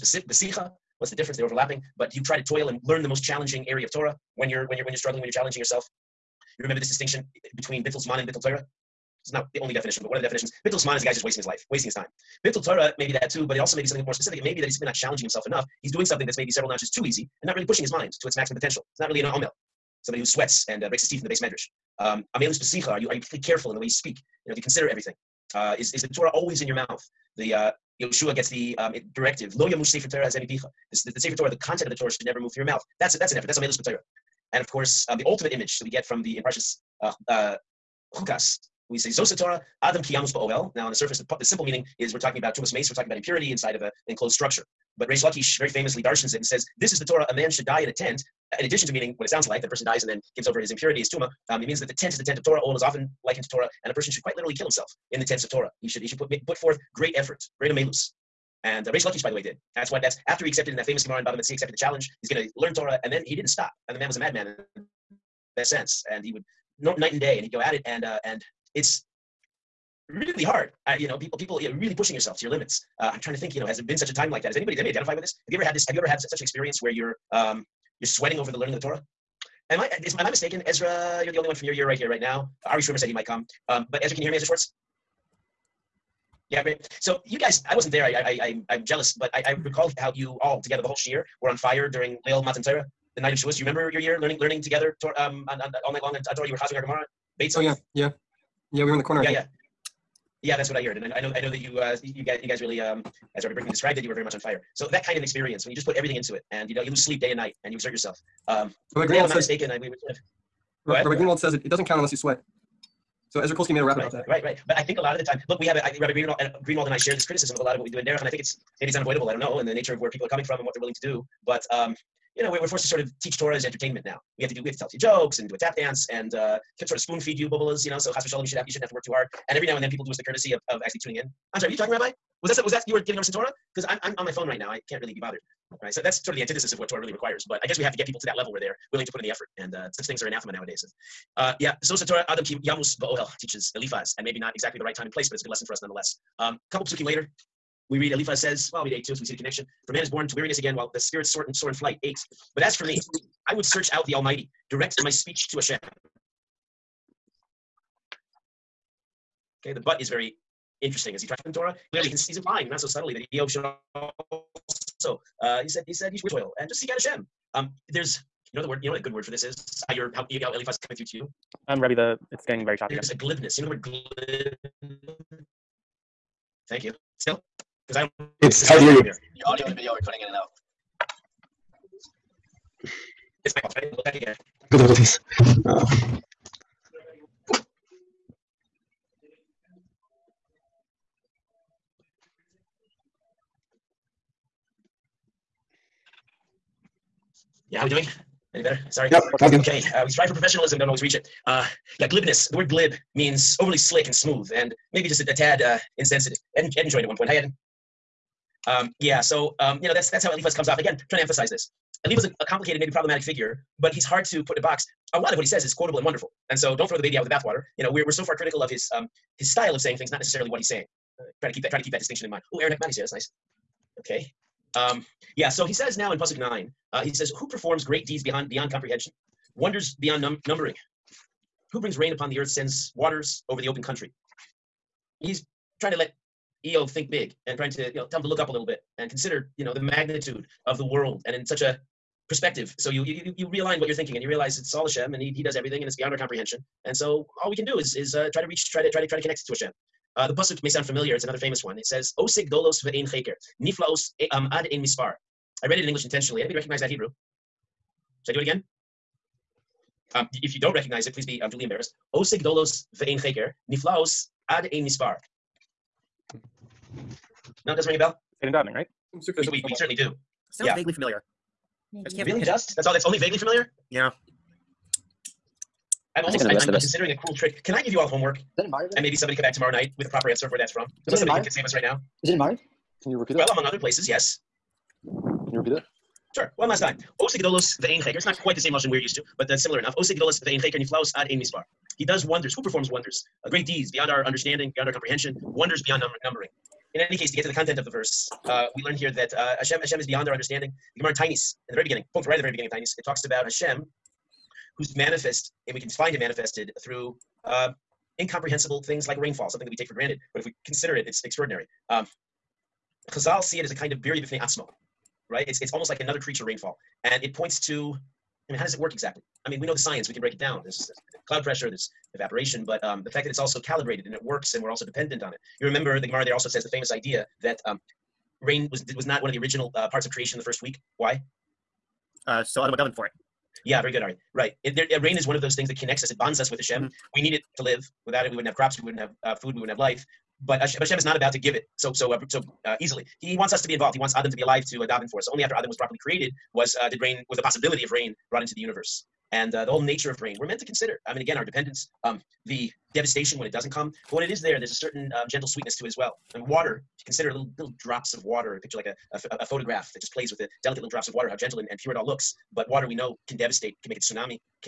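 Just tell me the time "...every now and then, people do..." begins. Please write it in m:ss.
2:09.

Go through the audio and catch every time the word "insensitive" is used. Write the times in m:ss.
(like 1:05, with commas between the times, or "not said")
3:25.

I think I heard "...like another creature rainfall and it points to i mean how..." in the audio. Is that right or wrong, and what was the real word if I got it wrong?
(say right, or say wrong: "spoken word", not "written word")
right.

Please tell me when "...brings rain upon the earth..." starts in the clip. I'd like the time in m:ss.
3:51.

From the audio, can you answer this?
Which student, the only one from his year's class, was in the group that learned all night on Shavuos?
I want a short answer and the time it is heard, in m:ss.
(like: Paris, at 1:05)
Ezra Schwartz, at 1:24.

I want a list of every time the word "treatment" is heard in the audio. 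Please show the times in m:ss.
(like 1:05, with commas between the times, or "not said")
not said.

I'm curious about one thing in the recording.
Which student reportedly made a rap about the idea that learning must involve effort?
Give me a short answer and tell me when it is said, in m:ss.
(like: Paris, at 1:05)
Ezra Kolsky, at 1:53.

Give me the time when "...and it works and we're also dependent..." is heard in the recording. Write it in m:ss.
5:24.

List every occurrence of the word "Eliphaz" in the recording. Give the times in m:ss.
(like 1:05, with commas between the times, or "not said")
2:23, 2:28, 2:50, 3:30.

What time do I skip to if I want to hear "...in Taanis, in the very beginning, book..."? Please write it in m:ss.
5:01.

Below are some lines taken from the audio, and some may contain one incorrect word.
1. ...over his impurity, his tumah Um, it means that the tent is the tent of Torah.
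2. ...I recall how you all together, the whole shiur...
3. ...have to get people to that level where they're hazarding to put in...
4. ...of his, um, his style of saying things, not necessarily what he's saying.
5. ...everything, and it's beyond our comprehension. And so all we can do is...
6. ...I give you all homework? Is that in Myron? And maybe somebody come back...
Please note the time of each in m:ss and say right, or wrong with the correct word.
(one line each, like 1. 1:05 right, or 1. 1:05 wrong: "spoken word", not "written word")
1. 0:50 right
2. 1:29 right
3. 2:17 wrong: "willing", not "hazarding"
4. 3:38 right
5. 4:05 right
6. 4:37 right.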